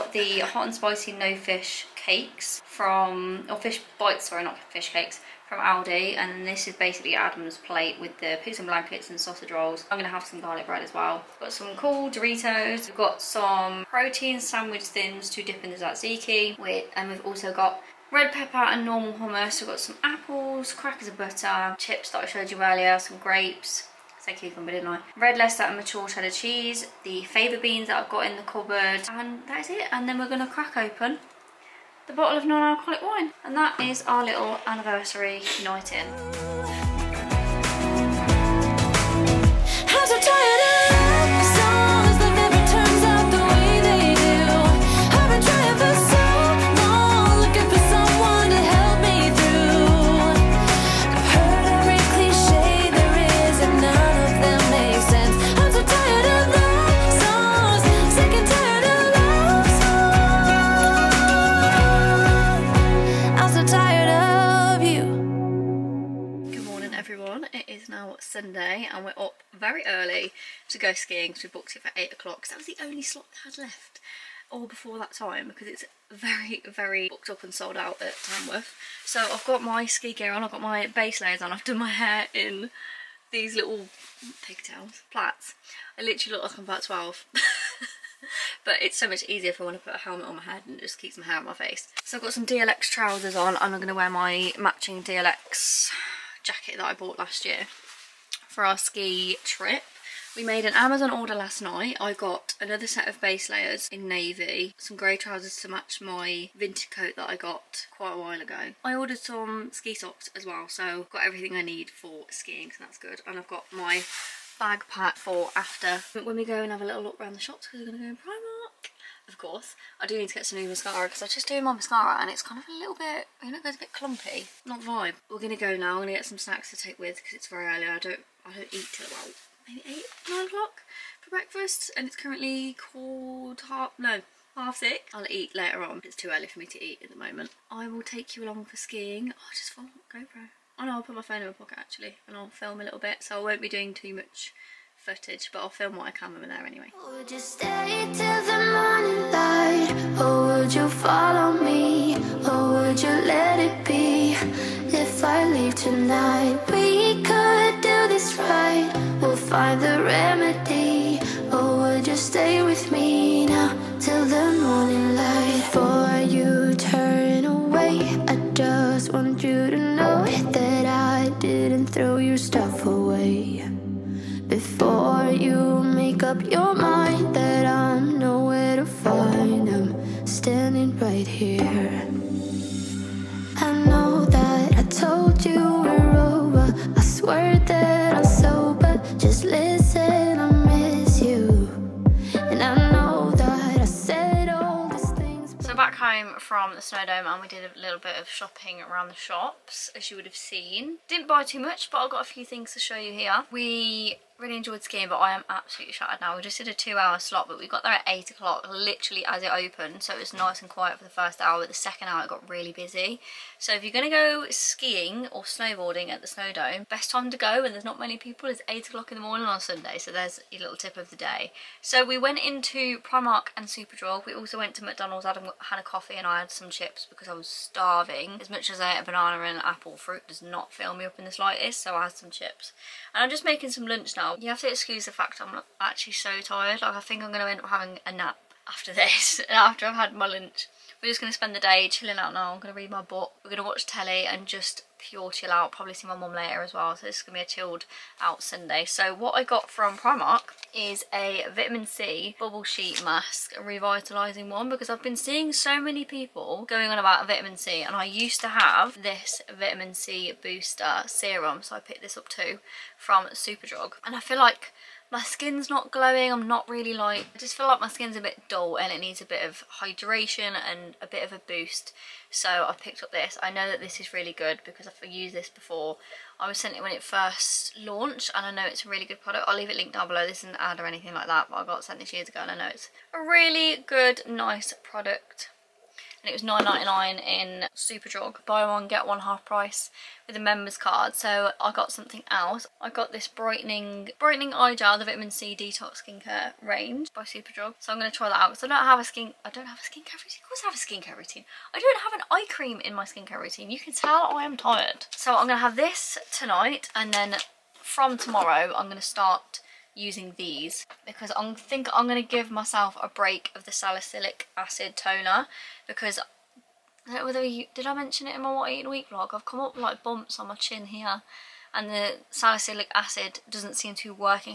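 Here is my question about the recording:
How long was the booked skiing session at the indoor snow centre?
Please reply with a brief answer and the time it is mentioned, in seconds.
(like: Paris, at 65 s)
2 hours, at 206 s.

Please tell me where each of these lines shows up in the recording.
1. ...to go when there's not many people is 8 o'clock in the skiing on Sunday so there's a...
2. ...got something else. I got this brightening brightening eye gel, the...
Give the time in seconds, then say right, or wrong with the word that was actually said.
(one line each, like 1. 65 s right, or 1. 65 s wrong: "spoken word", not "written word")
1. 217 s wrong: "morning", not "skiing"
2. 291 s right.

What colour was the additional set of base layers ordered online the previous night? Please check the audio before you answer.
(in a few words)
Navy.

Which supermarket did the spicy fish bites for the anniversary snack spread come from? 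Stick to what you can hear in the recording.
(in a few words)
Aldi.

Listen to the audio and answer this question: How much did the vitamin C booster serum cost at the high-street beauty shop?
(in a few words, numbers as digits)
£9.99.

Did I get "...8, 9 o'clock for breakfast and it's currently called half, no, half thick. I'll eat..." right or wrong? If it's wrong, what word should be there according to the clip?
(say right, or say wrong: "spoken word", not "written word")
right.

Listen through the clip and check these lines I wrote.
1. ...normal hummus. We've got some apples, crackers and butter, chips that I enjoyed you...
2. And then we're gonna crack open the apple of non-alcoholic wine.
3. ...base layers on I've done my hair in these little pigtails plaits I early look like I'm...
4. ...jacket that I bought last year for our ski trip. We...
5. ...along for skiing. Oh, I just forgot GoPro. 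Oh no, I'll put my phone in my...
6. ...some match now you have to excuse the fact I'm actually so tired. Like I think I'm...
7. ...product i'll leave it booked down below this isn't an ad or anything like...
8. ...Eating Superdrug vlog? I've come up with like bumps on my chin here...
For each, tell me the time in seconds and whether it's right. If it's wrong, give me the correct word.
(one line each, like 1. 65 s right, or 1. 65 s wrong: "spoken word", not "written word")
1. 18 s wrong: "showed", not "enjoyed"
2. 29 s wrong: "bottle", not "apple"
3. 80 s wrong: "literally", not "early"
4. 96 s right
5. 138 s right
6. 233 s wrong: "lunch", not "match"
7. 279 s wrong: "linked", not "booked"
8. 318 s wrong: "Week", not "Superdrug".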